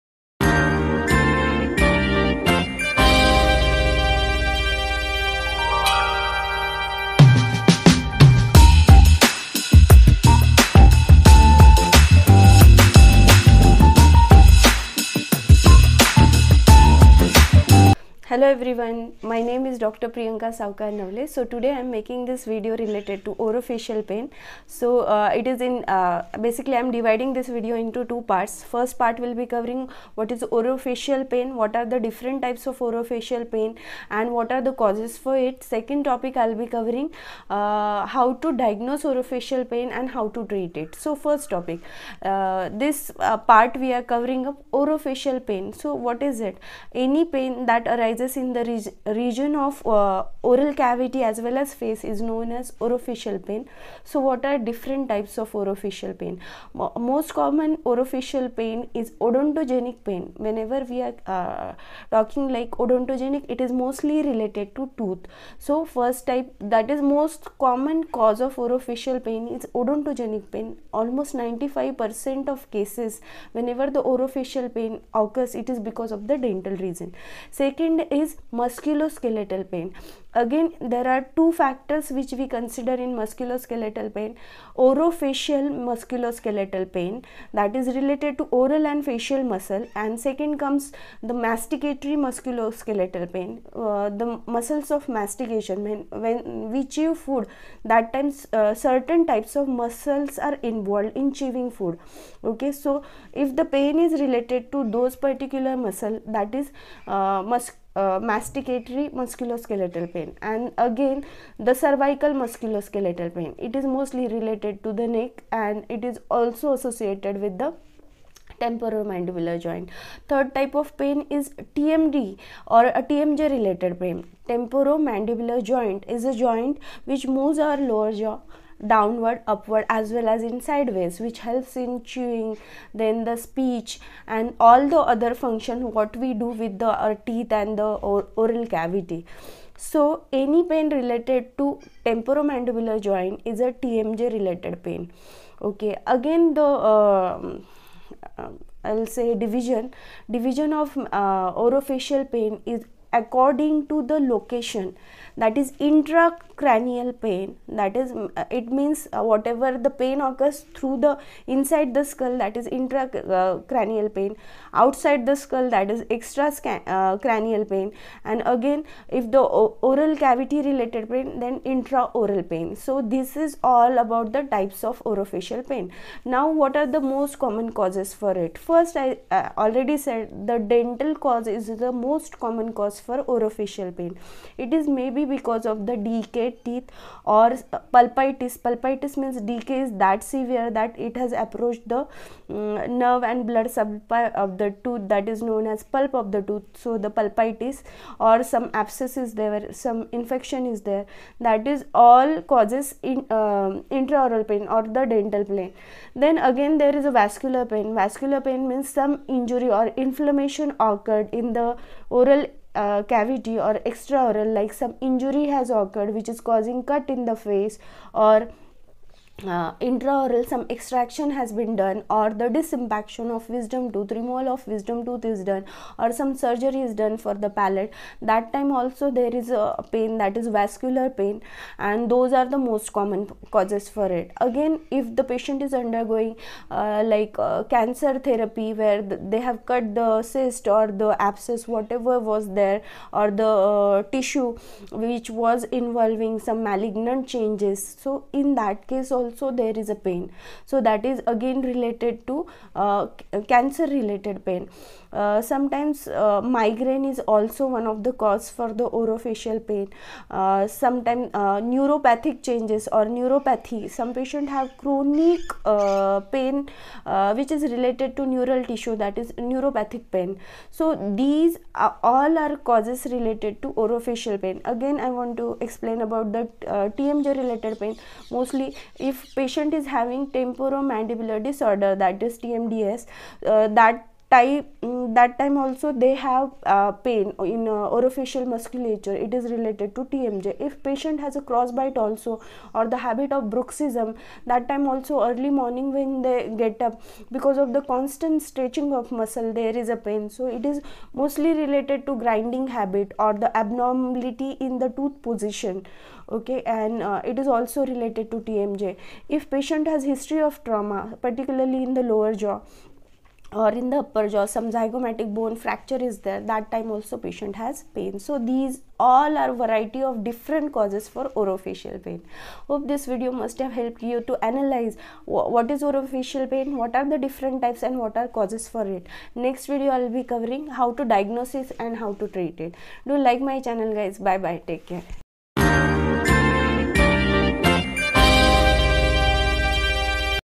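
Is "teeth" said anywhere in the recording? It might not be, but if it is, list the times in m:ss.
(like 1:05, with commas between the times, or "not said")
2:17, 3:06.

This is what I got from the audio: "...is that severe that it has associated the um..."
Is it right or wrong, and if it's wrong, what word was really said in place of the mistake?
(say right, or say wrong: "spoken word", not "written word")
wrong: "approached", not "associated".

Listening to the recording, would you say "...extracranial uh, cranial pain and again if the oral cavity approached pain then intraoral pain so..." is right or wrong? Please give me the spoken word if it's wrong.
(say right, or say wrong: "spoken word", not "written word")
wrong: "related", not "approached".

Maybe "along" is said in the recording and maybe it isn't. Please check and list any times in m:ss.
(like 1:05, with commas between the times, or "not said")
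not said.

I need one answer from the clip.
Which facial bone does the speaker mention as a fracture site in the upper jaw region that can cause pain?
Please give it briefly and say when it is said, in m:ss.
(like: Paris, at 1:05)
Zygomatic bone, at 5:14.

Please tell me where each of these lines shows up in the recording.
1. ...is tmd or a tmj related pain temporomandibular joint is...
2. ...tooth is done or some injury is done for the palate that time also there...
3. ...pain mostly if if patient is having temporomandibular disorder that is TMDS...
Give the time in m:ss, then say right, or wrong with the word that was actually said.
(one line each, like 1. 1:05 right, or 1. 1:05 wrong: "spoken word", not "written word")
1. 2:01 right
2. 3:45 wrong: "surgery", not "injury"
3. 4:37 right.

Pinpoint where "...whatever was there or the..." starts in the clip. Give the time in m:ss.
4:01.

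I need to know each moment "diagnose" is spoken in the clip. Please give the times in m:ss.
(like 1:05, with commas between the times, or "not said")
0:38, 5:31.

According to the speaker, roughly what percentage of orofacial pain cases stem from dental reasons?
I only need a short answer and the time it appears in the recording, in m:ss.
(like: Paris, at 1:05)
95%, at 1:11.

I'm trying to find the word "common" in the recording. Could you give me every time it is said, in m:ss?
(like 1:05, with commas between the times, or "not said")
0:57, 1:07, 2:57, 3:02, 3:52.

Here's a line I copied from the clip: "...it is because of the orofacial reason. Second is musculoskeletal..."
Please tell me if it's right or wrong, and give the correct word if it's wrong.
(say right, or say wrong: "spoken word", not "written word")
wrong: "dental", not "orofacial".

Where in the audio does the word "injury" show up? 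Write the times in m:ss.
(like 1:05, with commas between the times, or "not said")
3:29, 3:35.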